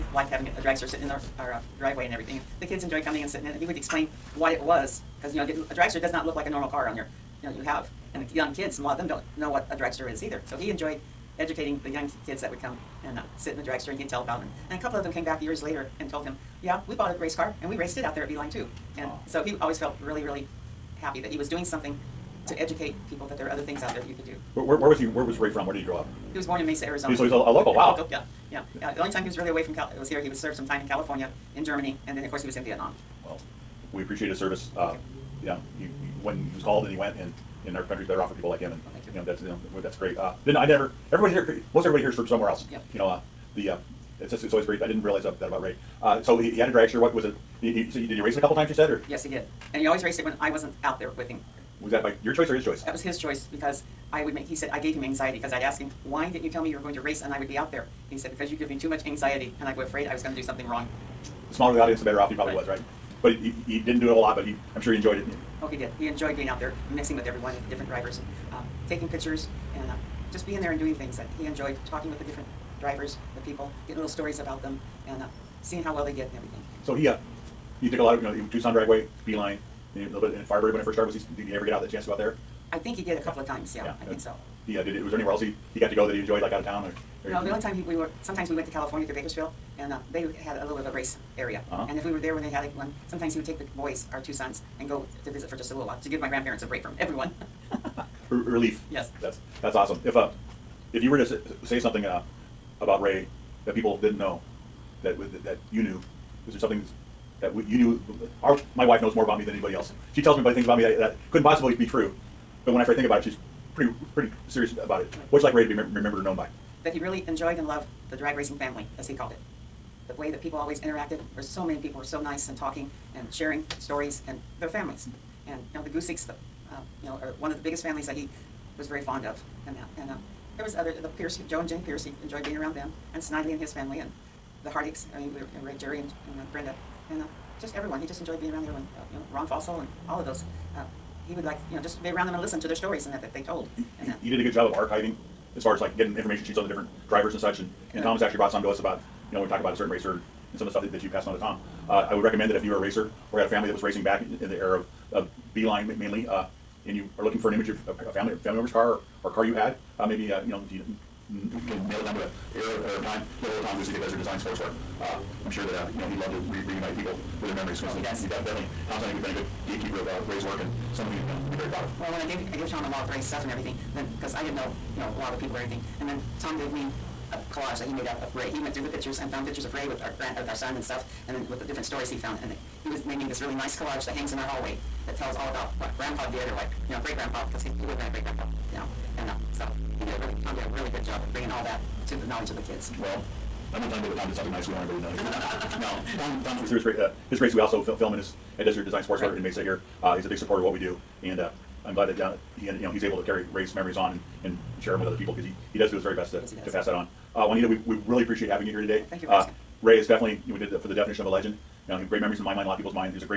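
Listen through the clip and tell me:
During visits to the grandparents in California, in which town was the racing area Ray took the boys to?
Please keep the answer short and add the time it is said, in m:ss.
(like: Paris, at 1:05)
Bakersfield, at 1:29.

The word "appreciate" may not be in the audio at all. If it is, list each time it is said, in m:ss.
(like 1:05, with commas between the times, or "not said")
0:34, 3:28.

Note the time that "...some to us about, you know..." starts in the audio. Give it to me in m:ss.
2:28.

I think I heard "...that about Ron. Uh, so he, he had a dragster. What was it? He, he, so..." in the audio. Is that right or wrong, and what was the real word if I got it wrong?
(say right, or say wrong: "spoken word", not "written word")
wrong: "Ray", not "Ron".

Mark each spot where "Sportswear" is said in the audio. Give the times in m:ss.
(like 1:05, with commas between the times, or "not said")
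2:44, 3:19.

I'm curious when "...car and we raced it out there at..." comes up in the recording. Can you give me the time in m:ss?
0:17.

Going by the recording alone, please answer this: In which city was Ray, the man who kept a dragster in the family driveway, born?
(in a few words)
Mesa, Arizona.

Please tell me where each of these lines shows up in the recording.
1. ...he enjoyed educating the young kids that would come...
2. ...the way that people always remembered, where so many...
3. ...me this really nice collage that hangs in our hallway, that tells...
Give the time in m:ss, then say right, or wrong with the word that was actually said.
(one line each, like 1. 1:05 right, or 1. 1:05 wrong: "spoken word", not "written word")
1. 0:10 right
2. 2:00 wrong: "interacted", not "remembered"
3. 3:03 right.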